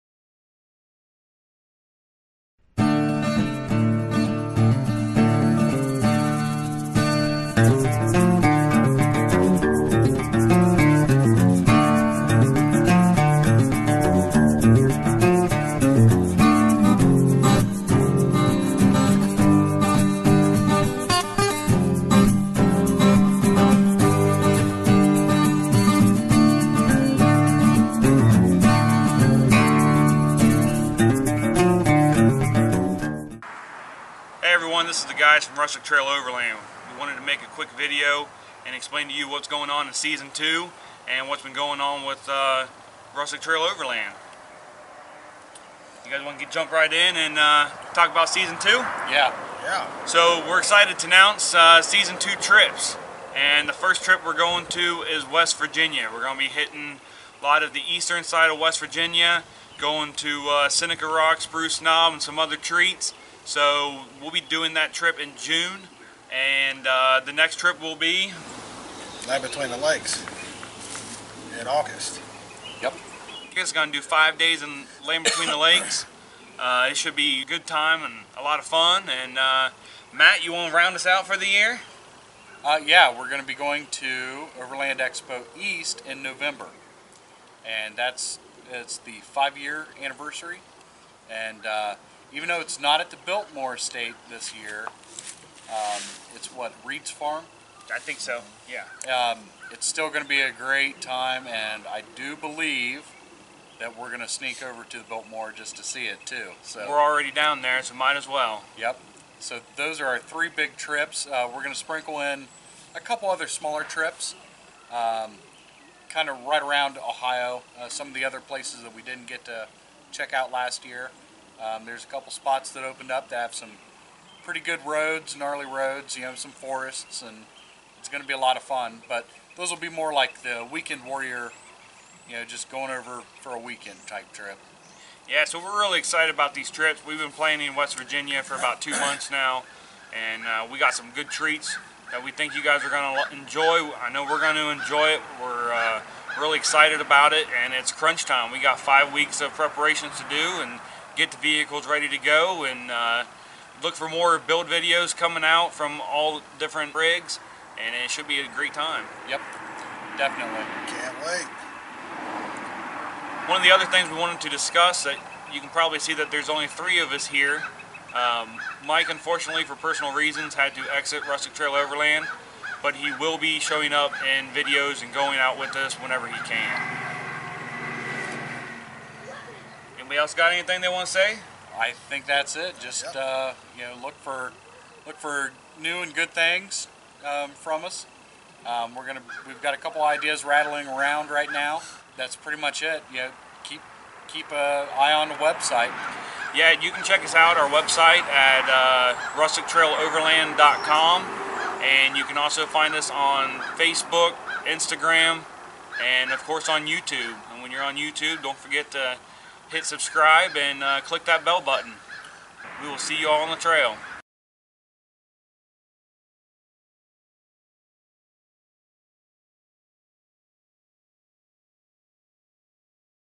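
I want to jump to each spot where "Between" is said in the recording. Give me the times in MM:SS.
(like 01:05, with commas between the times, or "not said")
01:09, 01:15.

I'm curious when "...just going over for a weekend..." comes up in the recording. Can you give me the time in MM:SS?
02:12.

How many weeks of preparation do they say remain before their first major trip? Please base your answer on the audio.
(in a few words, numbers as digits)
5.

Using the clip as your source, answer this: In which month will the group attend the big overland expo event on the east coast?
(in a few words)
November.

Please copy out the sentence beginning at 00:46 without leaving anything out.
You guys want to get, jump right in and uh, talk about Season 2?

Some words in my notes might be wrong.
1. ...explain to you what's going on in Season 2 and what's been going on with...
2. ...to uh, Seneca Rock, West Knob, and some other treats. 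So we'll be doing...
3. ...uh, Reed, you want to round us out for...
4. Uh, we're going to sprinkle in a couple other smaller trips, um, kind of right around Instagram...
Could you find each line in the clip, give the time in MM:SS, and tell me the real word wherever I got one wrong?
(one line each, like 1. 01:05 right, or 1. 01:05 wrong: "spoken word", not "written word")
1. 00:38 right
2. 01:00 wrong: "Spruce", not "West"
3. 01:19 wrong: "Matt", not "Reed"
4. 01:51 wrong: "Ohio", not "Instagram".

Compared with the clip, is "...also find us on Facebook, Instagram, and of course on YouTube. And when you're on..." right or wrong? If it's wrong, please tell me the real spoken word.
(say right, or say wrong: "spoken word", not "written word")
right.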